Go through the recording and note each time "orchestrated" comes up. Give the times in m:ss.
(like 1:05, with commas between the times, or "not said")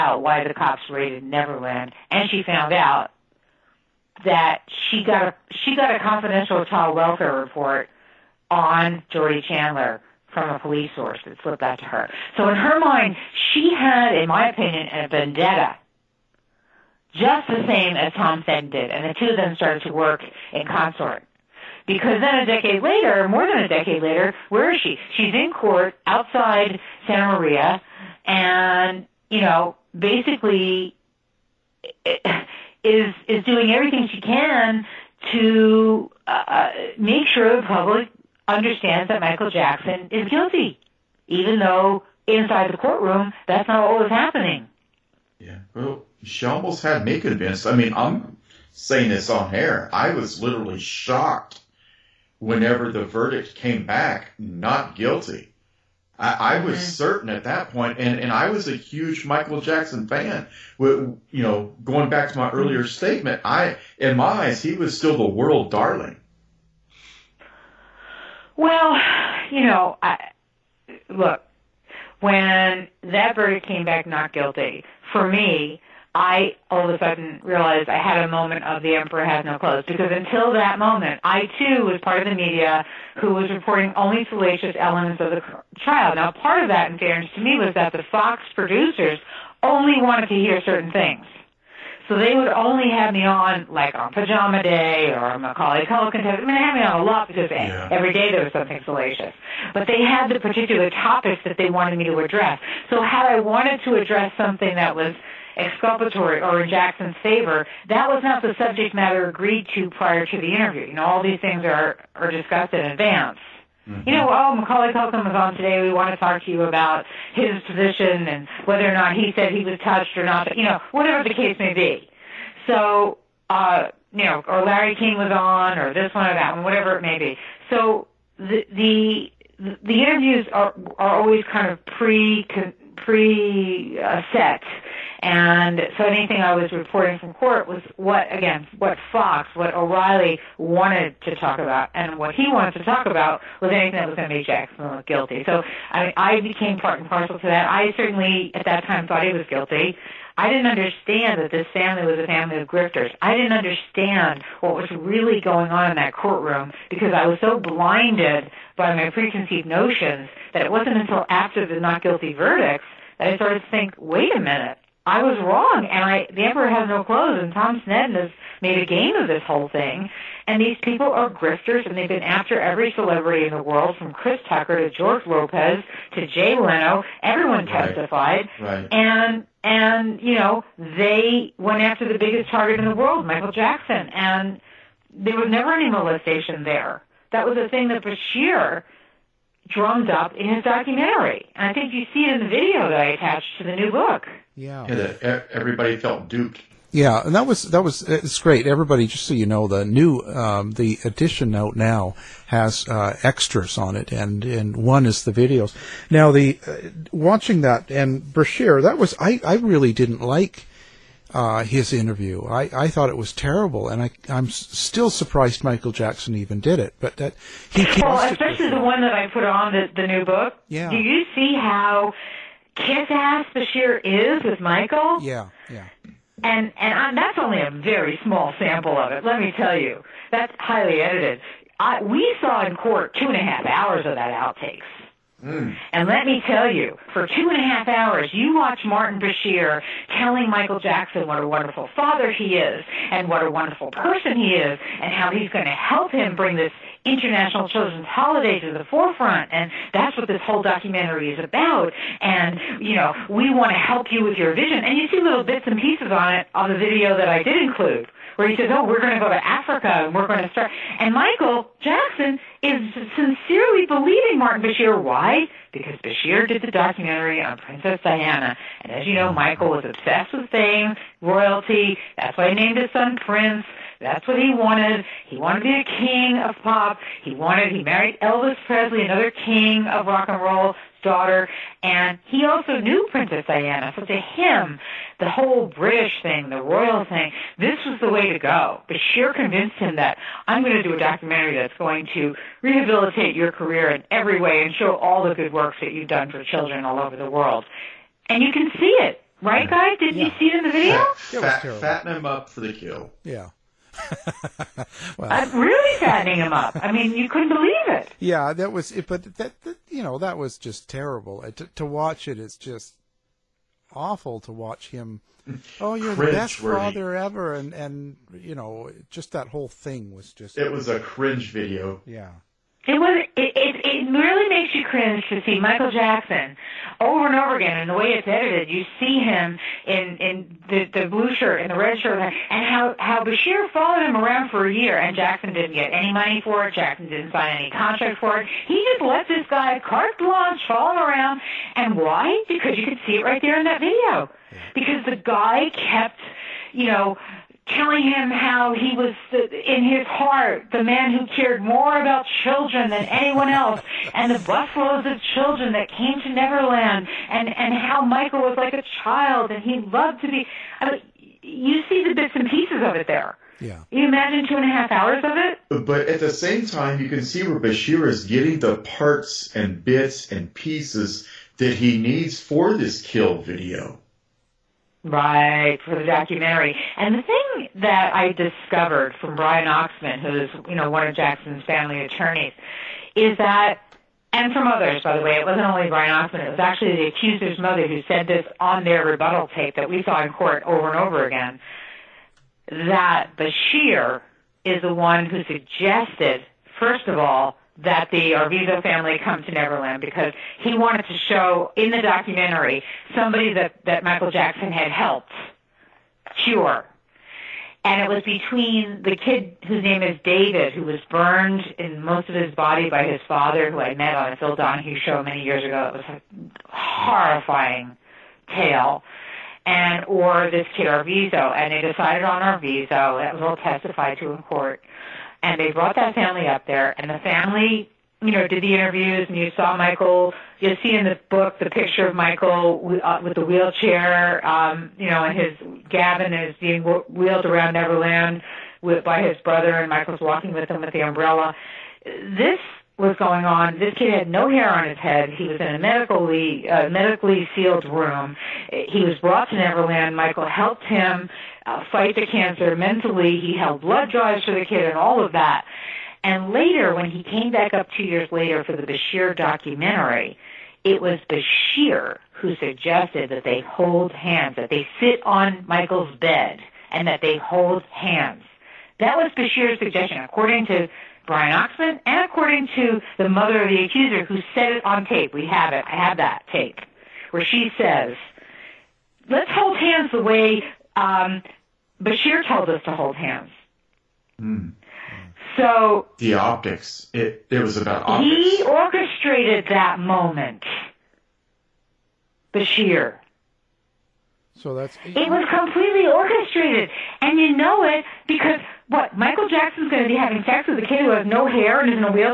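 8:08, 8:16.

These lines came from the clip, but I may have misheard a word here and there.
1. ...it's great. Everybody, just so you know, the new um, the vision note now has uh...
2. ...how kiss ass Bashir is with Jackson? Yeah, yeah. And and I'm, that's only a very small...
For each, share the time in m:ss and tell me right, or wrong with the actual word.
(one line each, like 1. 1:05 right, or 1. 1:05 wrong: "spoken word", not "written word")
1. 3:18 wrong: "edition", not "vision"
2. 3:41 wrong: "Michael", not "Jackson".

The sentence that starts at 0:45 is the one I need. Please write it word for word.
Yeah, well, she almost had me convinced.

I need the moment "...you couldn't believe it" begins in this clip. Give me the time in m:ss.
5:07.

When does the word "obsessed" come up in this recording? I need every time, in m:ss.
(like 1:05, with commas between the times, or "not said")
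4:29.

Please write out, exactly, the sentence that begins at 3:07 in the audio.
That was a thing that Bashir drummed up in his documentary.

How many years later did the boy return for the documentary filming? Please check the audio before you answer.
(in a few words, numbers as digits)
2.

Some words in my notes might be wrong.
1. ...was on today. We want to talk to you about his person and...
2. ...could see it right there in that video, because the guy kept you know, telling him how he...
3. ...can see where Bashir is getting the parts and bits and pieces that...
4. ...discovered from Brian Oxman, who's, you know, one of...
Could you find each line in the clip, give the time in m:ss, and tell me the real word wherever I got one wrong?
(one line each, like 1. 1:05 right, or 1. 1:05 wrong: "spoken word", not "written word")
1. 1:55 wrong: "position", not "person"
2. 5:42 right
3. 6:07 right
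4. 6:18 right.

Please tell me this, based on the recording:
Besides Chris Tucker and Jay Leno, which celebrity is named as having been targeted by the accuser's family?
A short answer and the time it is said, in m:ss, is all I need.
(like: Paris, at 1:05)
George Lopez, at 2:54.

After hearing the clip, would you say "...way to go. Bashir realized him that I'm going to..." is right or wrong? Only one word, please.
wrong.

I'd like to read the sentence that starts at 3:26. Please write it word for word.
Now the uh, watching that and Bashir, that was I I really didn't like uh, his interview.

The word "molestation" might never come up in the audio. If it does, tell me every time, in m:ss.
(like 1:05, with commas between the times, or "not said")
3:05.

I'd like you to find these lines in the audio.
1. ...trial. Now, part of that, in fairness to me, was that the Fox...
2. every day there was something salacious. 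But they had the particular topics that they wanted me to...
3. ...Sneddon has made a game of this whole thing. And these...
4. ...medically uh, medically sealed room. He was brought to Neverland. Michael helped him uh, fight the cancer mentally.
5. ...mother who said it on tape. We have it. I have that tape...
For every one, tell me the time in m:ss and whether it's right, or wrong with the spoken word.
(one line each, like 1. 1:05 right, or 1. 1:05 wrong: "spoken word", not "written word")
1. 1:25 right
2. 1:37 right
3. 2:47 right
4. 7:25 right
5. 7:53 wrong: "accuser", not "mother".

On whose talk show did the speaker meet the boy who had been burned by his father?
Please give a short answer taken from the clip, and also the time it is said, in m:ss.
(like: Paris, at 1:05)
Phil Donahue, at 6:54.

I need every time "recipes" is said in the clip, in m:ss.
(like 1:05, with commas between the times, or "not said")
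not said.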